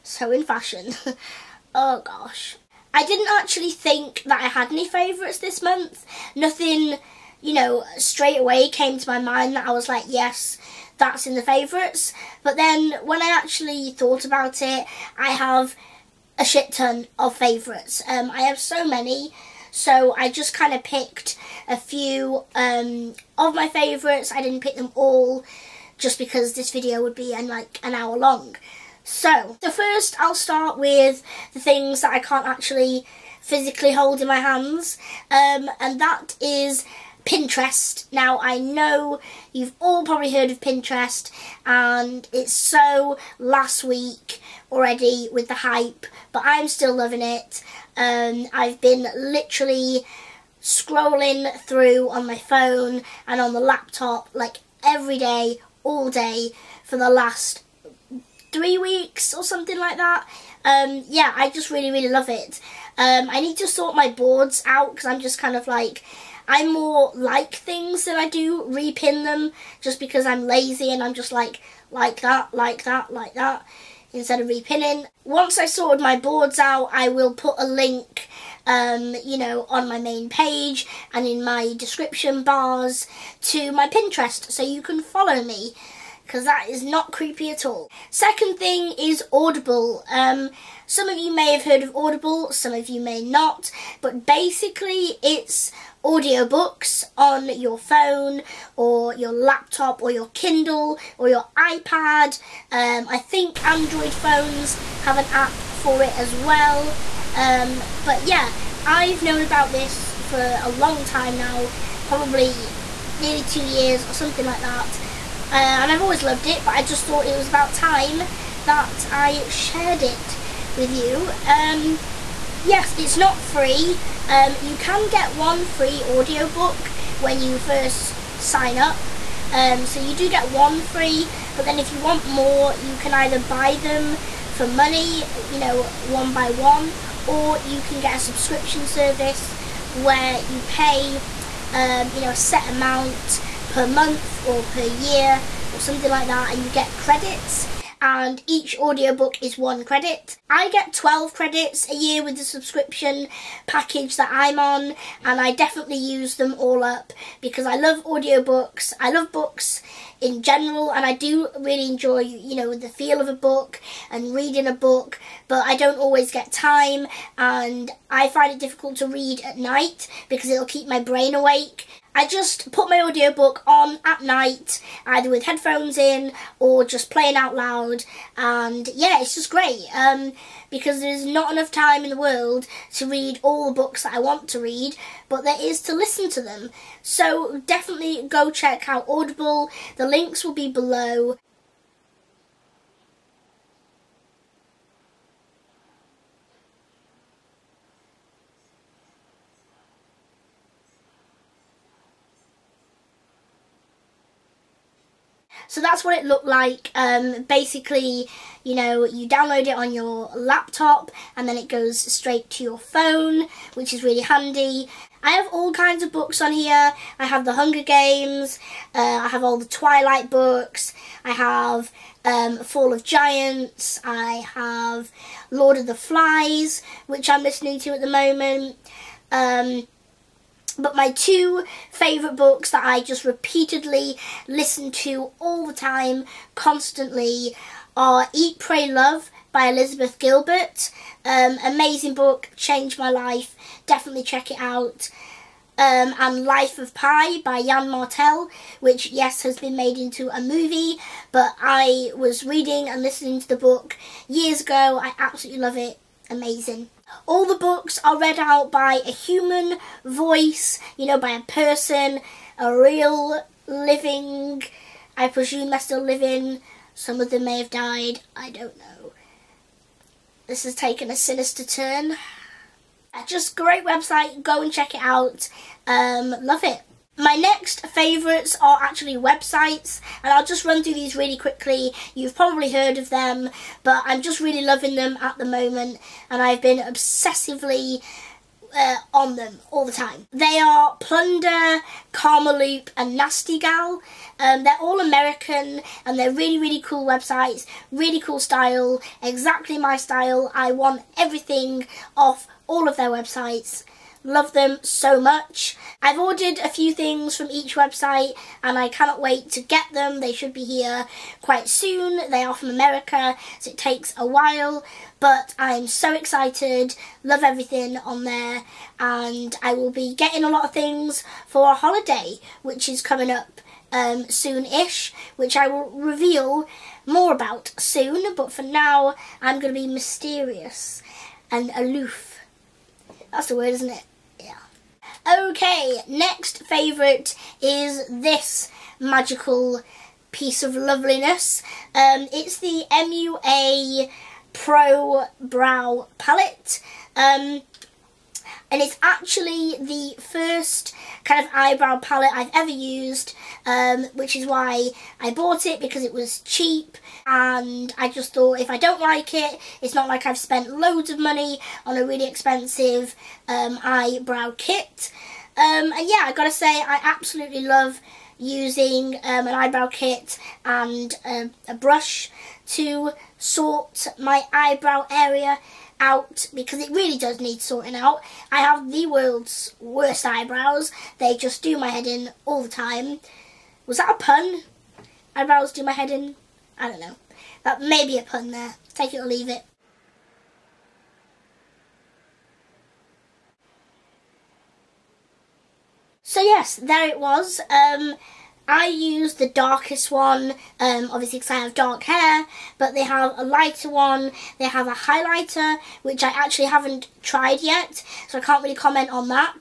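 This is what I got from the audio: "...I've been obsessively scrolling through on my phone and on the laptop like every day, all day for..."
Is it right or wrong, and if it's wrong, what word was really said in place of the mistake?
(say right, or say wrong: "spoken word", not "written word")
wrong: "literally", not "obsessively".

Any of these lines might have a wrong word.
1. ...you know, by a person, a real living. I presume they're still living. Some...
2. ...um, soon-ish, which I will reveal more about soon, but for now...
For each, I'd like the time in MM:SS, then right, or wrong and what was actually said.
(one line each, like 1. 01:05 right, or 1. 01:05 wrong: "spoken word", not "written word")
1. 04:20 right
2. 05:23 right.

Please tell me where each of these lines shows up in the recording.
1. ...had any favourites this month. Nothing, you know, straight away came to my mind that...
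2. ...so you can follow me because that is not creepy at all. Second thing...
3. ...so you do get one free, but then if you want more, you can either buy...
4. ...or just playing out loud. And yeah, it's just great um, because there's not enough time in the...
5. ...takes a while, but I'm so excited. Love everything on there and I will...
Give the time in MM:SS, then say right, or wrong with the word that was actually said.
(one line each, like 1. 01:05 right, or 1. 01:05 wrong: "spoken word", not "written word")
1. 00:04 right
2. 01:24 right
3. 02:09 right
4. 02:56 right
5. 05:13 right.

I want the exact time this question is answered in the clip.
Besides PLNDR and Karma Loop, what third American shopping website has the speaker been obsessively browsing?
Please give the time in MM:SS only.
04:53.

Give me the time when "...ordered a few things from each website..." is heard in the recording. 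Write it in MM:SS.
05:06.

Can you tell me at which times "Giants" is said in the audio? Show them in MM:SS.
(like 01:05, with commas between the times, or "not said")
03:43.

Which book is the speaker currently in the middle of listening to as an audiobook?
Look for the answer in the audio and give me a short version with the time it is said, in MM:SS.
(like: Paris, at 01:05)
Lord of the Flies, at 03:45.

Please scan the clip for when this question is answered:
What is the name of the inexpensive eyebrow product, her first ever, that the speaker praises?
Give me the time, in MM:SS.
05:42.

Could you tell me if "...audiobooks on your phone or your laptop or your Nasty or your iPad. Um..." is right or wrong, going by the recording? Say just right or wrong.
wrong.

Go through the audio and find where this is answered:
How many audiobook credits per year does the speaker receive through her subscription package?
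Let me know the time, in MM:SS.
02:30.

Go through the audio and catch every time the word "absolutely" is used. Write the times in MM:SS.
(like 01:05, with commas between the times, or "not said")
04:15, 06:07.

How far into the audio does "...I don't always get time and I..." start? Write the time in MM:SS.
02:45.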